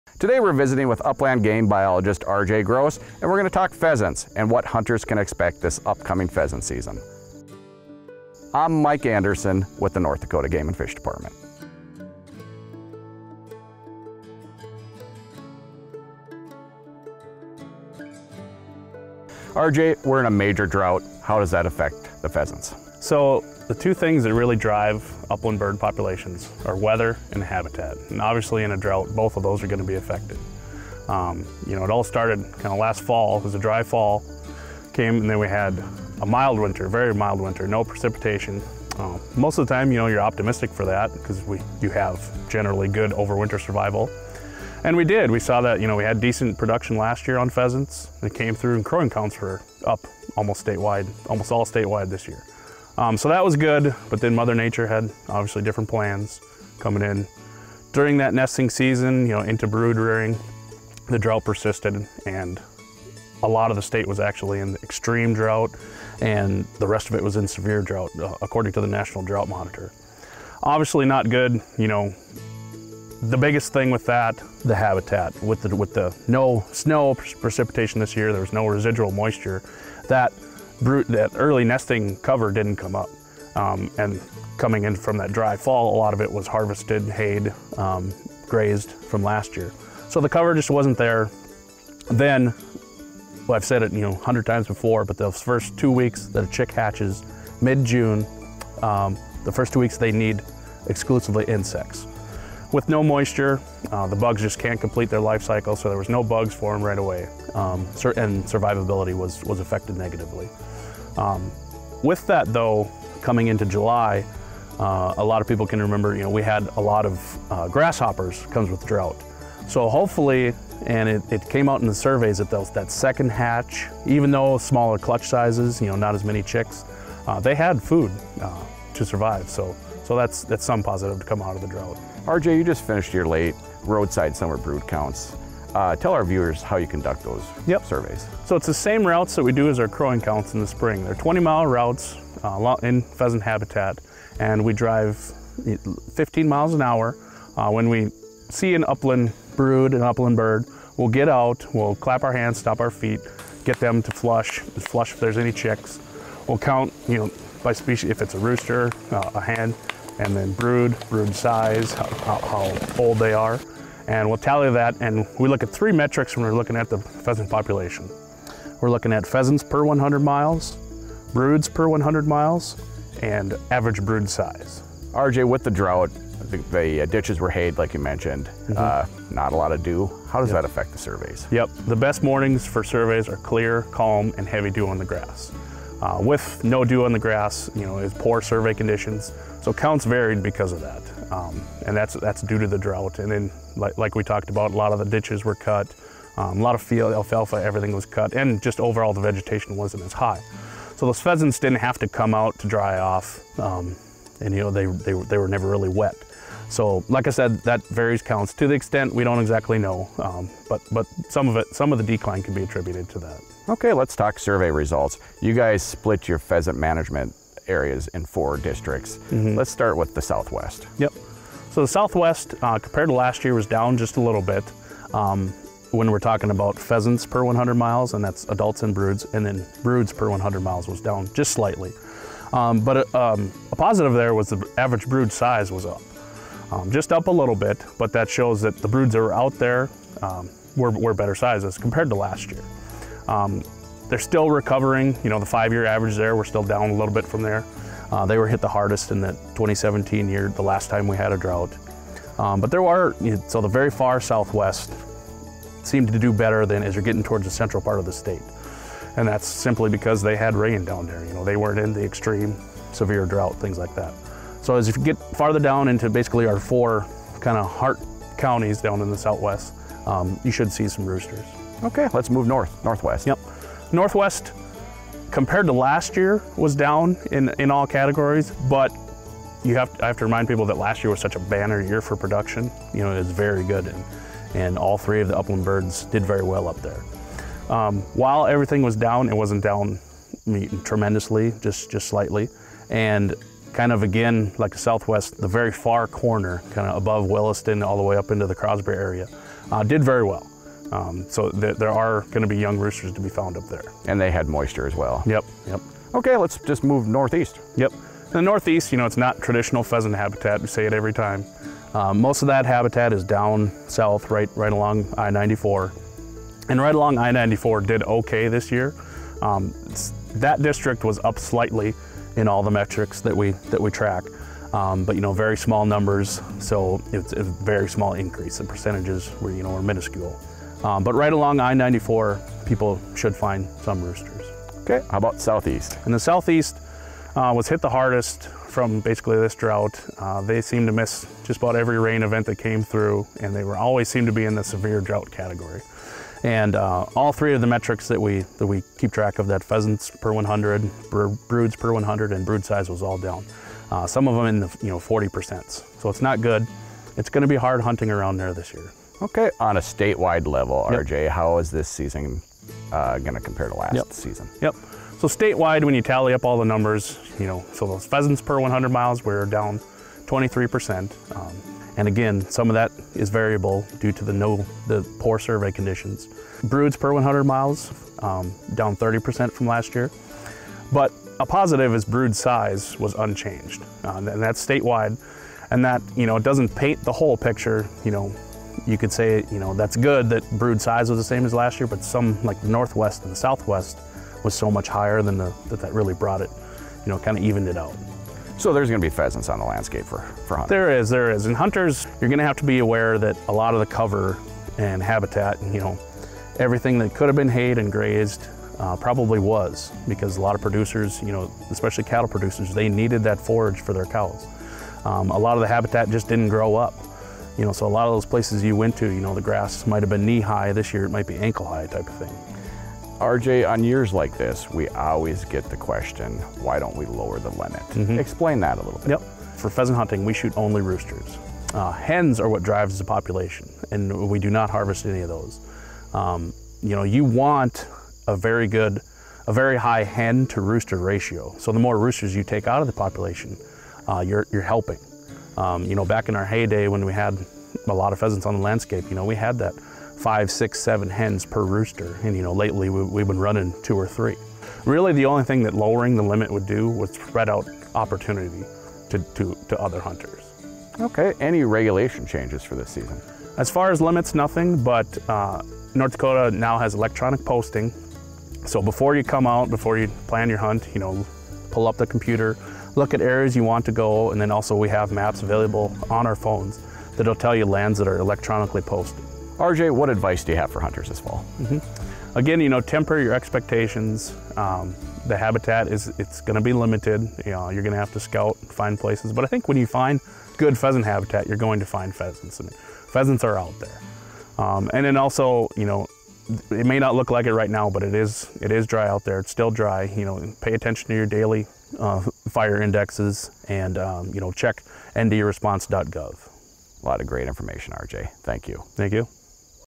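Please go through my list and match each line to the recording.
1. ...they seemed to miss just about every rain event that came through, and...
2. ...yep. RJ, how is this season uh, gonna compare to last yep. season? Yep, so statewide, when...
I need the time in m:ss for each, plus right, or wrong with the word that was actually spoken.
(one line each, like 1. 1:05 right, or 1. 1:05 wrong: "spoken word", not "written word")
1. 5:40 right
2. 6:00 right.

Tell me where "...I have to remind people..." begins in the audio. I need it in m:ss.
4:40.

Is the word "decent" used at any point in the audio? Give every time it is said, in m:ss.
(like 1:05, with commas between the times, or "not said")
0:46.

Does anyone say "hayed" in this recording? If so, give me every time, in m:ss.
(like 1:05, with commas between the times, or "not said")
1:27, 2:57, 6:47.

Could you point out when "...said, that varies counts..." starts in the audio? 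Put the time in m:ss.
3:27.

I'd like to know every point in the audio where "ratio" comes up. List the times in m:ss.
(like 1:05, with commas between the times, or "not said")
7:21.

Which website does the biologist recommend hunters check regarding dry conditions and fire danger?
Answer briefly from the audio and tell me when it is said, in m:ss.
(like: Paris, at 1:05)
ndresponse.gov, at 8:25.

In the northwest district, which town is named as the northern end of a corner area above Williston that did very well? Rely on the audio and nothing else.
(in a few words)
Crosby.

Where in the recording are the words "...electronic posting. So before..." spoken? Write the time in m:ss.
7:46.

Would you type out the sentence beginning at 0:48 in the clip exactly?
It came through and crowing counts were up almost statewide, almost all statewide this year.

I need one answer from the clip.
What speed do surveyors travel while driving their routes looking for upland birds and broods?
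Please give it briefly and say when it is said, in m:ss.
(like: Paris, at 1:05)
15 miles an hour, at 2:26.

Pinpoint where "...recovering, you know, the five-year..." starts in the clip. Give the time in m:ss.
4:04.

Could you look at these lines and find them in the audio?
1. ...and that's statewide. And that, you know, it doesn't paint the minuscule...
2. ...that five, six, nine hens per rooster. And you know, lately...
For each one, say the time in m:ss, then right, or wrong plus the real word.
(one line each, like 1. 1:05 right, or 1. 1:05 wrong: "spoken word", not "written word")
1. 6:24 wrong: "whole", not "minuscule"
2. 7:29 wrong: "seven", not "nine".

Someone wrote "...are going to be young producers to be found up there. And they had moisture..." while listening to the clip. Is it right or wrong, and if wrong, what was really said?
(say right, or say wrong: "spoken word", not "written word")
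wrong: "roosters", not "producers".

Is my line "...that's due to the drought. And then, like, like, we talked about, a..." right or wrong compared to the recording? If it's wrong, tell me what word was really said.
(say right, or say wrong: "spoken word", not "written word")
right.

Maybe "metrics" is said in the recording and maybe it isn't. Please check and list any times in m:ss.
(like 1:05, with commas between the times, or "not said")
2:45, 5:22, 5:47.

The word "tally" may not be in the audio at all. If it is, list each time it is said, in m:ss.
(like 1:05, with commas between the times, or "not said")
2:44, 6:06.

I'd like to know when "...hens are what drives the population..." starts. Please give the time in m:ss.
7:12.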